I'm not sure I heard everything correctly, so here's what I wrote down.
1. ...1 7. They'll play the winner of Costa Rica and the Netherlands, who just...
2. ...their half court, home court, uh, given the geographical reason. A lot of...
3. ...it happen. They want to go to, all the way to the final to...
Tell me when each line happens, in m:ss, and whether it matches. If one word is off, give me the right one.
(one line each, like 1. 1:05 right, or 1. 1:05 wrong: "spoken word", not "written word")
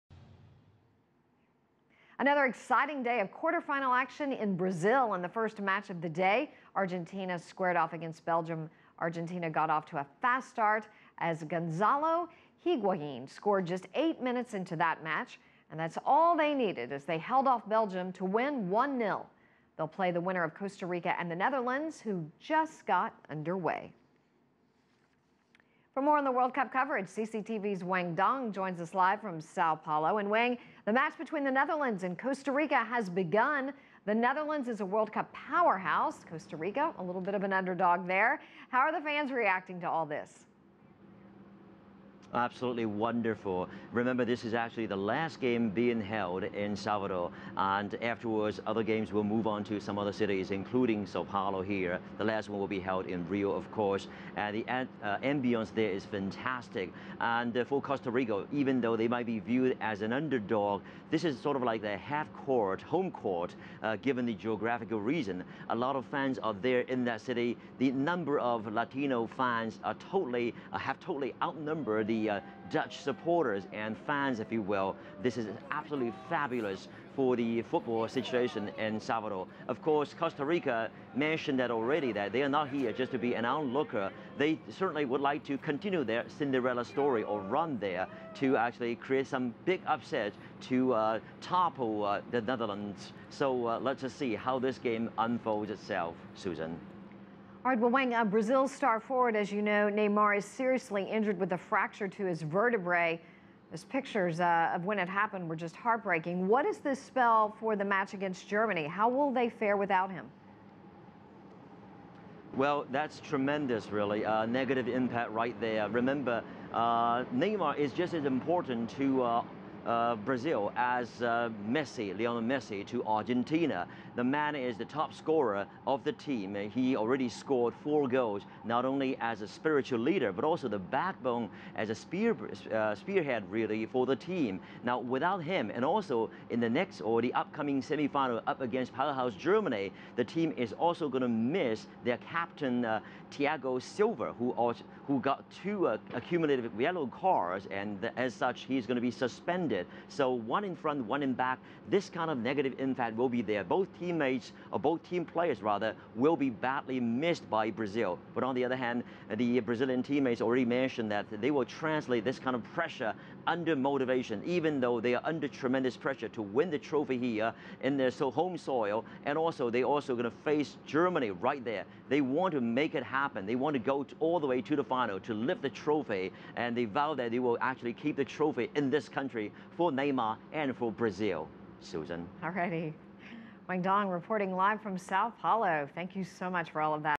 1. 0:18 wrong: "0", not "7"
2. 1:01 right
3. 2:52 right.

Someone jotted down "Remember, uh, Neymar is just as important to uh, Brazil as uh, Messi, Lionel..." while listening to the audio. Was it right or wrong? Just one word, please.
right.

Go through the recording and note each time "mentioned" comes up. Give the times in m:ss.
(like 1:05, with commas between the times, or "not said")
1:21, 2:40.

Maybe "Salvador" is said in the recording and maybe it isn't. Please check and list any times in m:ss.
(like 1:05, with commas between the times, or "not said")
0:46, 1:18.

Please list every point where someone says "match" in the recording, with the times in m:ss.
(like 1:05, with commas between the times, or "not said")
0:05, 0:15, 0:30, 1:47.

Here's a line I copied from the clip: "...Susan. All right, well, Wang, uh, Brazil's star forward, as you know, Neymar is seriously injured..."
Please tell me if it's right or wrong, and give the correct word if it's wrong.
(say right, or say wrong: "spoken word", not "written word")
right.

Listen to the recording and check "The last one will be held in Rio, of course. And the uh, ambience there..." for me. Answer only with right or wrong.
right.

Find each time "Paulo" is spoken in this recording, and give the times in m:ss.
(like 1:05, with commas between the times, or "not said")
0:29, 0:51, 3:05.